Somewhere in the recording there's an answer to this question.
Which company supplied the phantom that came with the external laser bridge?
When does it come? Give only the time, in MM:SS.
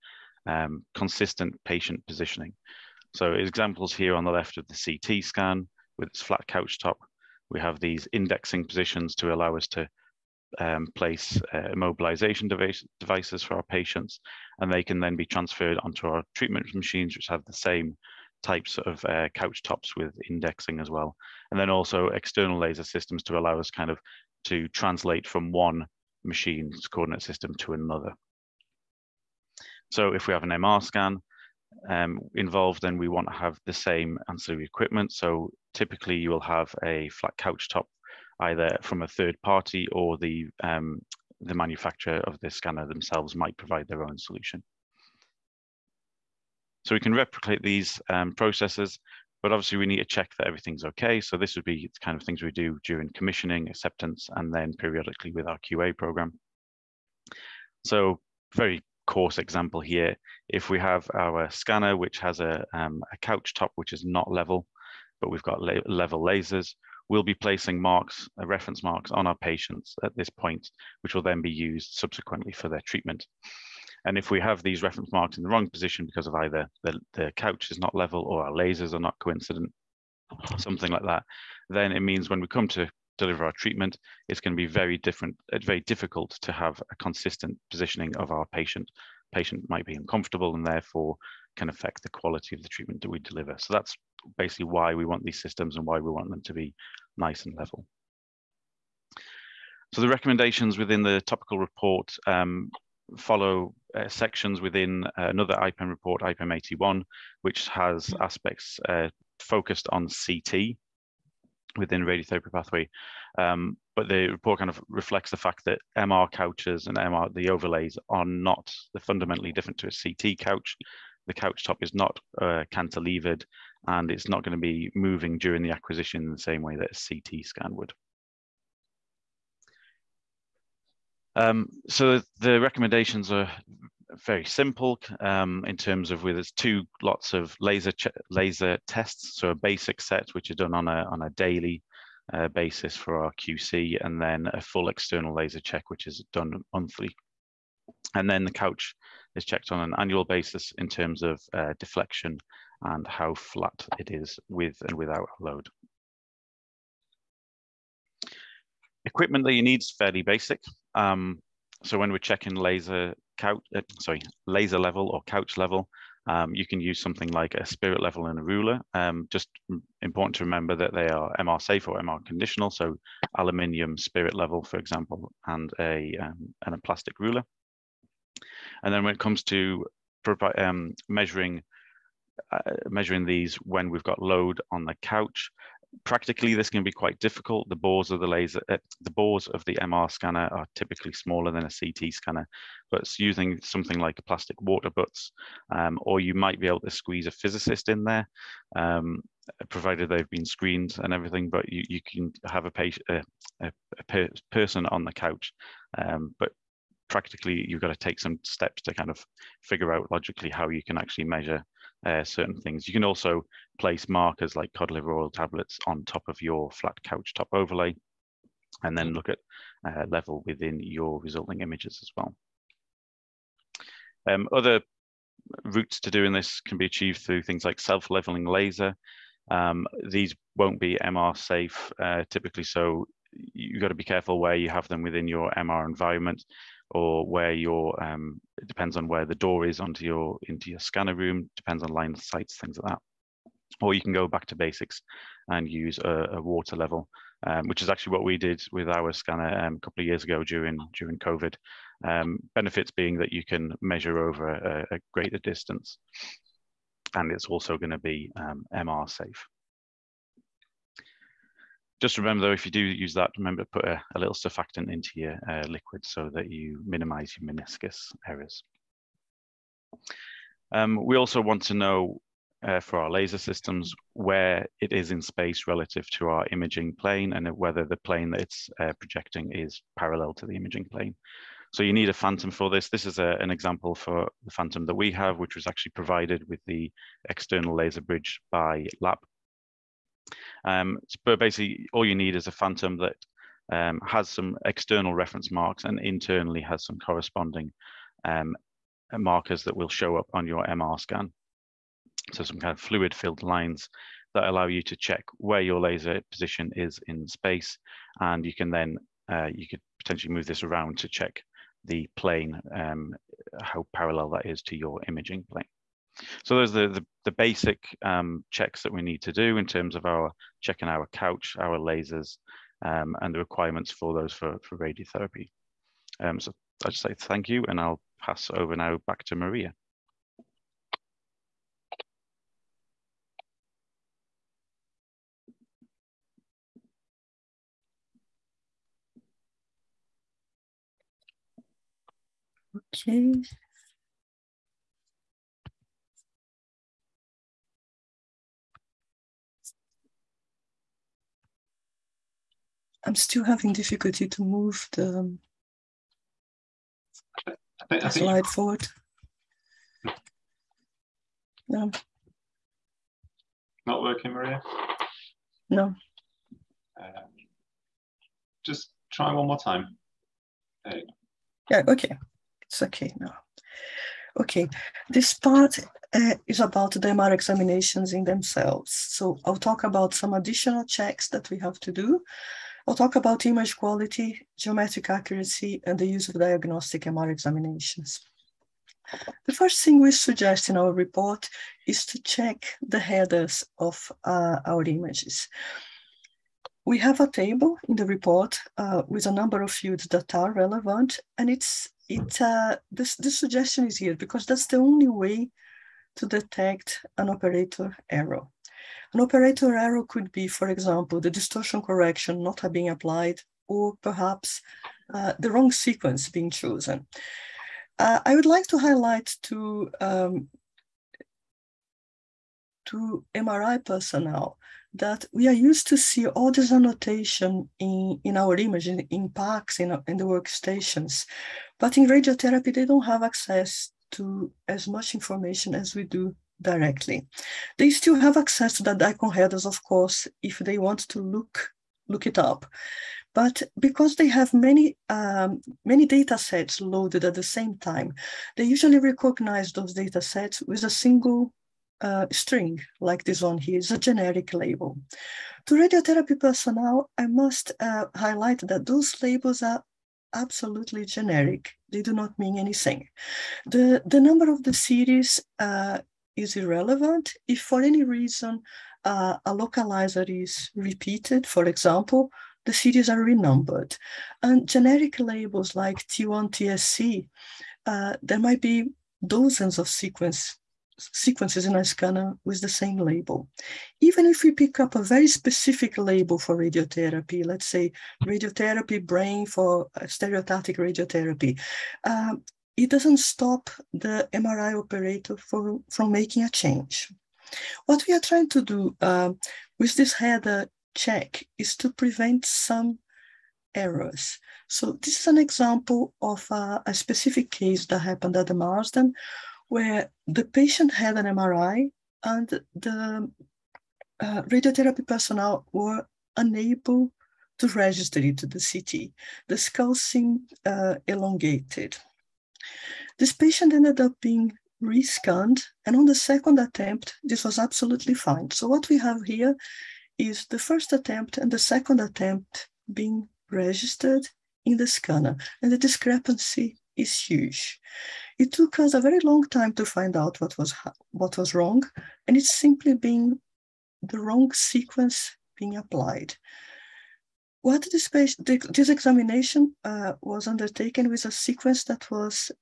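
04:49.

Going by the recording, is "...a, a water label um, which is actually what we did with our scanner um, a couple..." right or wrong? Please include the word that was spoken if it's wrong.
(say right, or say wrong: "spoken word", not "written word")
wrong: "level", not "label".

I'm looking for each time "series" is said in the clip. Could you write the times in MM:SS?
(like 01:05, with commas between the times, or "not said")
07:44, 07:52.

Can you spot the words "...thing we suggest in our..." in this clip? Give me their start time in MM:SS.
06:29.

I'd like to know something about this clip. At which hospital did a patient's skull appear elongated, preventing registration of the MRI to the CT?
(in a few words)
The Marsden.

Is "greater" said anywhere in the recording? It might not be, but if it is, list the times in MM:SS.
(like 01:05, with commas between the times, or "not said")
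04:15.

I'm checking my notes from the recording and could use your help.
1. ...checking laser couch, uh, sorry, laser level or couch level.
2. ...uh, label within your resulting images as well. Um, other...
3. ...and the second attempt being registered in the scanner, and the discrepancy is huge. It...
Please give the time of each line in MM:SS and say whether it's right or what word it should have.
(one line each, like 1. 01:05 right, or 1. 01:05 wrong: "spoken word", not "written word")
1. 02:42 right
2. 03:39 wrong: "level", not "label"
3. 08:51 right.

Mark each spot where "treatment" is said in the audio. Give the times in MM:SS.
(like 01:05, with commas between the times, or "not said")
00:16, 01:12, 01:23, 01:32.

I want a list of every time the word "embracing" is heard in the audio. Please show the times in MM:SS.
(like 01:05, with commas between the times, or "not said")
not said.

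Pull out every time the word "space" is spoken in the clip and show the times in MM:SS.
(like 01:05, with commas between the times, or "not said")
04:35, 05:07.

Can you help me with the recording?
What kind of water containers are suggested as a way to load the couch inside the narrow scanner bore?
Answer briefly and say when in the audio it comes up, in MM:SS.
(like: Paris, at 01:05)
Plastic water butts, at 03:14.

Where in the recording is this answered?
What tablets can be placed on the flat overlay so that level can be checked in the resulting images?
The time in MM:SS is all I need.
03:34.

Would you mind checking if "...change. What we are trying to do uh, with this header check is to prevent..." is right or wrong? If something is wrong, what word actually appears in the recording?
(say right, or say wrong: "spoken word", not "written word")
right.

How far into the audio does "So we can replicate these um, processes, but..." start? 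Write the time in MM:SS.
00:46.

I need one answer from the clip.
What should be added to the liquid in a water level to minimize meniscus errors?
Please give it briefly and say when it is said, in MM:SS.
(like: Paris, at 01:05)
Surfactant, at 04:24.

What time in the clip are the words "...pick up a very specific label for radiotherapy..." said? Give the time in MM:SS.
08:04.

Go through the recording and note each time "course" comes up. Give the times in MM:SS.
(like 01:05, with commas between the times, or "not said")
00:59, 07:19.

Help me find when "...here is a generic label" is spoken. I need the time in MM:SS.
07:33.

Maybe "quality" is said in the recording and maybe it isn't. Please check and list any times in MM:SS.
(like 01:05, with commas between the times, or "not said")
01:32, 06:23.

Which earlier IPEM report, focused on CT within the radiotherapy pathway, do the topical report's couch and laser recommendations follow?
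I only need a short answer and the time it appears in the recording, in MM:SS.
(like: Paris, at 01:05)
IPEM 81, at 01:46.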